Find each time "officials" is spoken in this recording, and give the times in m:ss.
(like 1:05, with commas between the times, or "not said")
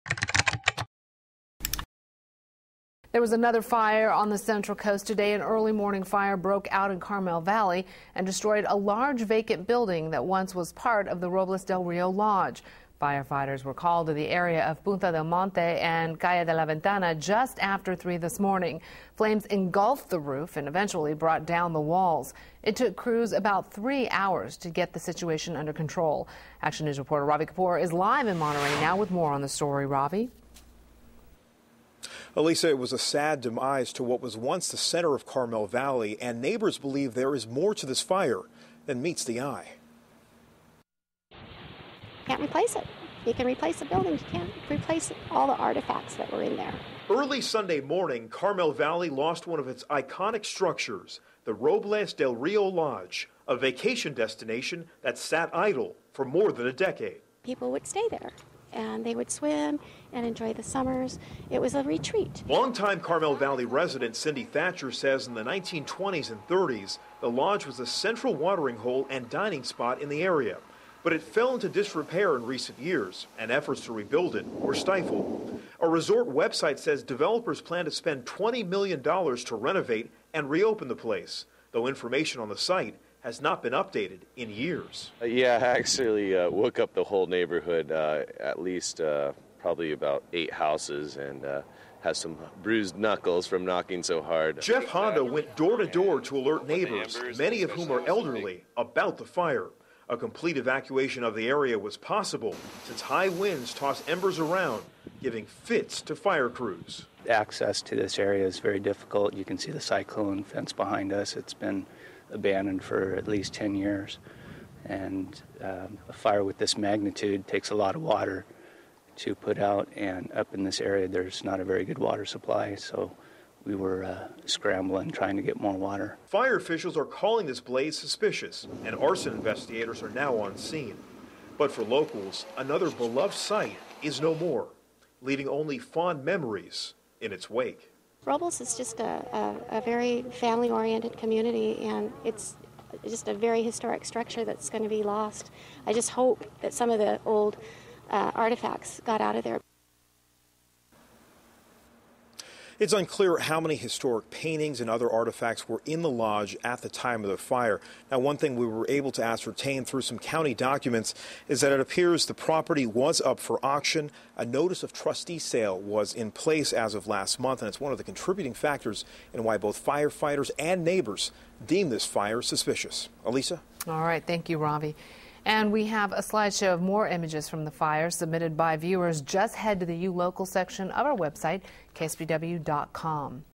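2:06.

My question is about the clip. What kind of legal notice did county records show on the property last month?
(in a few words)
Notice of trustee sale.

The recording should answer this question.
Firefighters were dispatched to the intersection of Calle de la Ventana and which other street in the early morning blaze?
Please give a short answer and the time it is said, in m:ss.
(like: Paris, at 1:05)
Punta del Monte, at 0:14.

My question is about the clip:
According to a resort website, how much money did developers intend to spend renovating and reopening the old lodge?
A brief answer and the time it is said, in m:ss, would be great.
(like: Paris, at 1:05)
$20 million, at 1:18.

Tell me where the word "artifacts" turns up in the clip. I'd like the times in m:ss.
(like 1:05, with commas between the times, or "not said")
0:45, 2:28, 2:35.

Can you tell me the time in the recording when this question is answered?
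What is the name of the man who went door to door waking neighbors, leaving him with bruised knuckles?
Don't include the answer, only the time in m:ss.
1:34.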